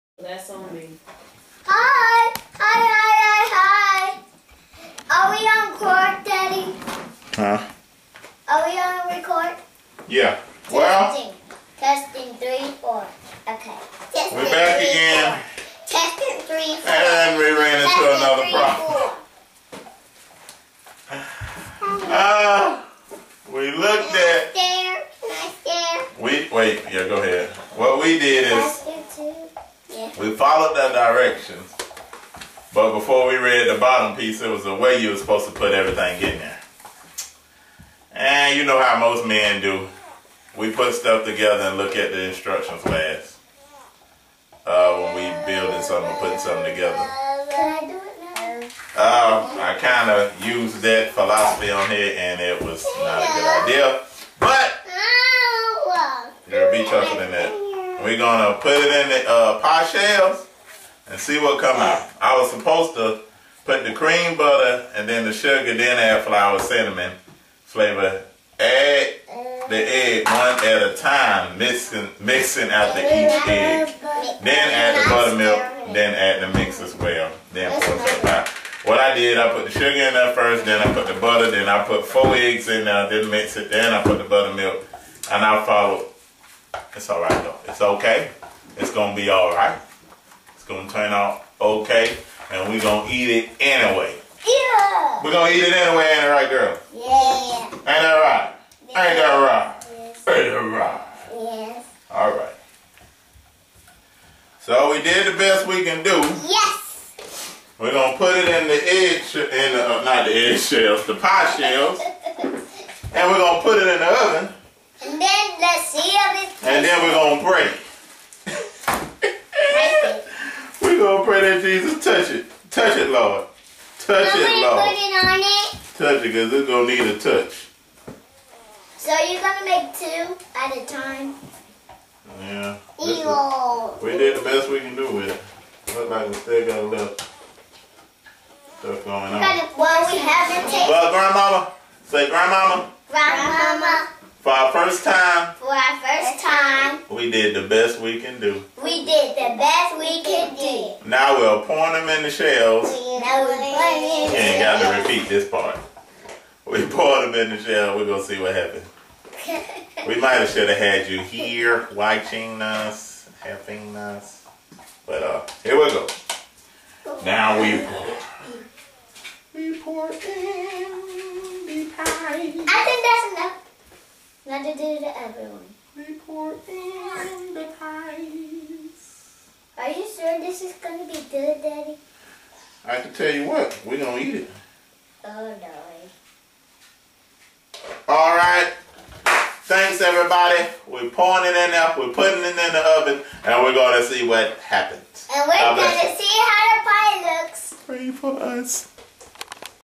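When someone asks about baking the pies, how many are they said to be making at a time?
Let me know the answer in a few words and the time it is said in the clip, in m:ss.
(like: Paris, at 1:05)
2, at 2:09.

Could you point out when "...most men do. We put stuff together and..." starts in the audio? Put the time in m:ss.
0:38.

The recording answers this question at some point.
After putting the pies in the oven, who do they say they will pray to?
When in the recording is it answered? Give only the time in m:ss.
2:01.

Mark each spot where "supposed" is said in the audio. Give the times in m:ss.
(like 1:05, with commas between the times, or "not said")
0:35, 1:02.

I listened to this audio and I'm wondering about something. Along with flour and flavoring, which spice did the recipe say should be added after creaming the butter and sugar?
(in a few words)
Cinnamon.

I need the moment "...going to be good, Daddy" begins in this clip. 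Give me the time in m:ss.
3:00.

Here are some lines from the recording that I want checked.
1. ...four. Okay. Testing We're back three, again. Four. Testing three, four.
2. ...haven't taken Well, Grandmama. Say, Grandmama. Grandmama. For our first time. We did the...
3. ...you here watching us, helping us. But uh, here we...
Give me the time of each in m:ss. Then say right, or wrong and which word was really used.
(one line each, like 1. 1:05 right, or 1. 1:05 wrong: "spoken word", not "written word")
1. 0:12 right
2. 2:20 right
3. 2:41 right.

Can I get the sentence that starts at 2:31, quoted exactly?
Now we'll pour them in the shells.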